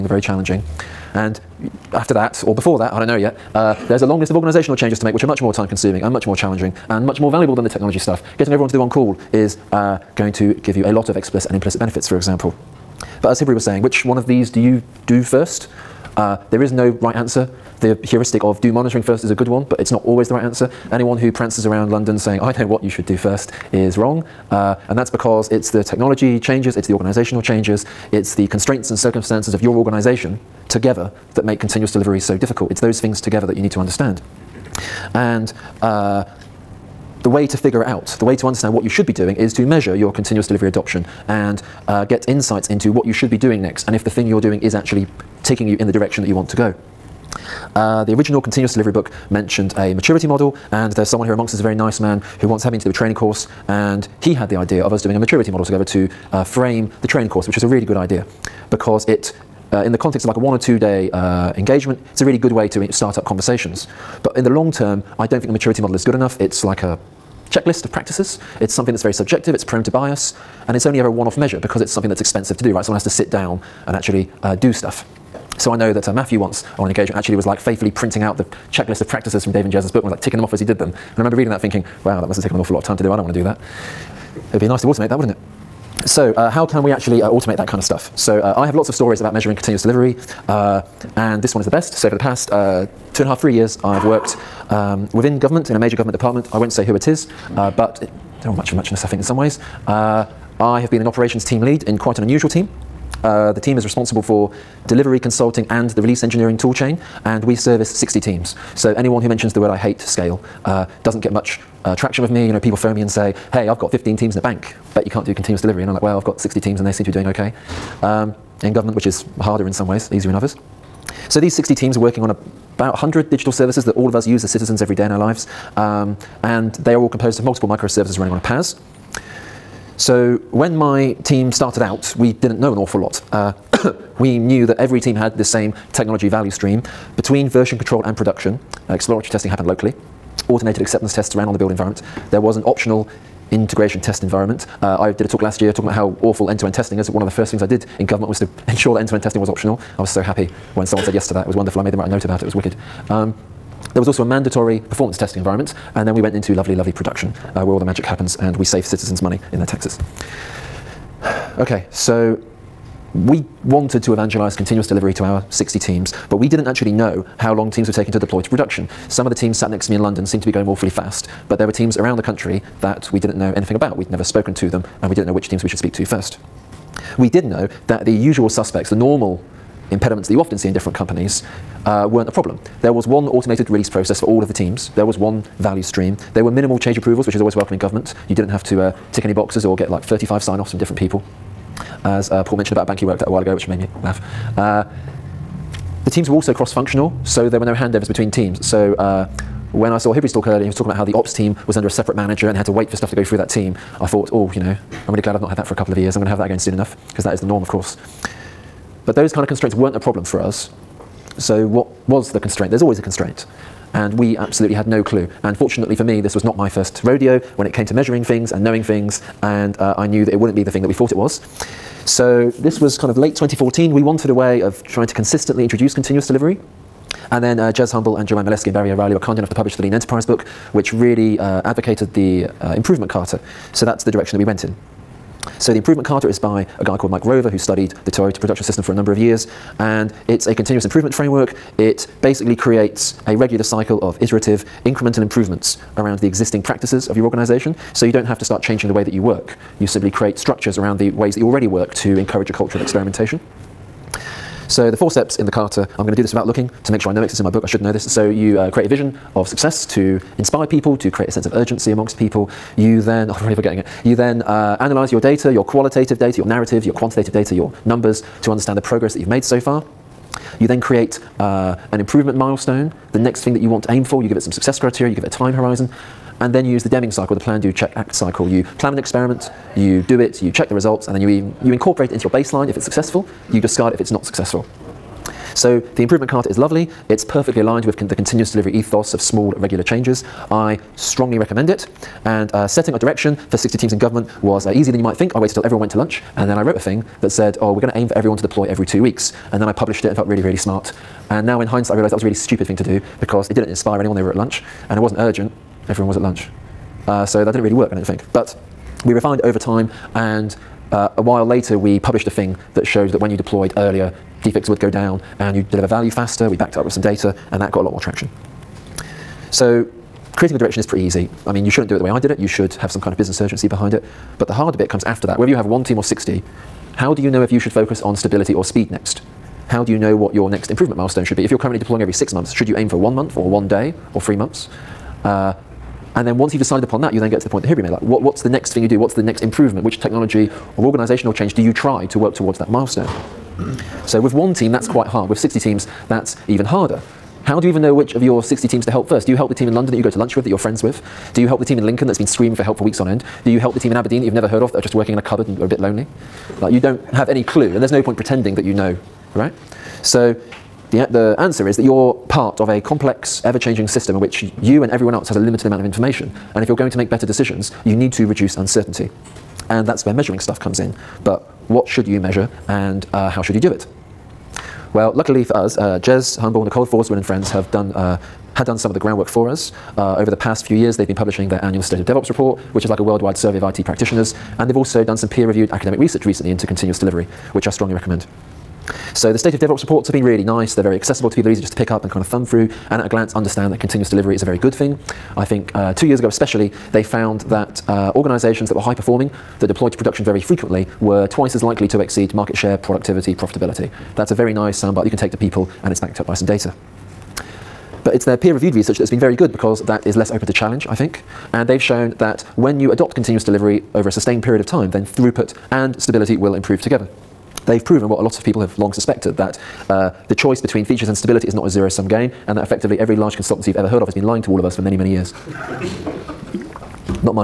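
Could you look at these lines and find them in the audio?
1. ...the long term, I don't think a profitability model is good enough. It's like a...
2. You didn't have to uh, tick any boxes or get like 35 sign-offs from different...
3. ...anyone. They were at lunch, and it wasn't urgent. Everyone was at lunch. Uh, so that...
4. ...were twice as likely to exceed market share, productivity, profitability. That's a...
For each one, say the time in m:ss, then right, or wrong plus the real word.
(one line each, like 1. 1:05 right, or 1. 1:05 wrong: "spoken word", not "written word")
1. 1:04 wrong: "maturity", not "profitability"
2. 3:08 right
3. 5:03 right
4. 6:40 right.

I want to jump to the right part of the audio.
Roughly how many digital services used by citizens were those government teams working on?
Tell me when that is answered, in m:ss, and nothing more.
2:02.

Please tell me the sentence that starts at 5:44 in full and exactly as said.
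So with one team, that's quite hard.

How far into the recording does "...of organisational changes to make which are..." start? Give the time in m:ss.
0:04.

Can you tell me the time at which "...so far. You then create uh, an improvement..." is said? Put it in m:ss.
4:29.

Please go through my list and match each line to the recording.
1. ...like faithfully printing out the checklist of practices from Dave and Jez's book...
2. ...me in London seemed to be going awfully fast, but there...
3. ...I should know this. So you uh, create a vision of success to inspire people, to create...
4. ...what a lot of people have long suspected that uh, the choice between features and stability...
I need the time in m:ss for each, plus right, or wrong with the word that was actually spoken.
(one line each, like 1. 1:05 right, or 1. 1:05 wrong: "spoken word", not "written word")
1. 1:17 right
2. 2:49 right
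3. 4:17 right
4. 6:58 right.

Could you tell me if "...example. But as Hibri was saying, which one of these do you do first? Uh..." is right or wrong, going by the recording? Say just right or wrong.
right.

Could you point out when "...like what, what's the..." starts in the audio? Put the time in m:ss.
5:37.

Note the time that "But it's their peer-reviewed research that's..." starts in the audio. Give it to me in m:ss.
6:48.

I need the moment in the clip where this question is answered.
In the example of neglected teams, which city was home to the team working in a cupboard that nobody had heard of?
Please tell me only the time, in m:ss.
5:53.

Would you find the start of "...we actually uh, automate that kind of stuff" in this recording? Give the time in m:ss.
1:26.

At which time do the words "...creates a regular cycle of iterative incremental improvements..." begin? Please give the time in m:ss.
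4:02.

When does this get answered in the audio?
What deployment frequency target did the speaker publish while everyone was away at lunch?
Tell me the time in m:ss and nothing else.
4:58.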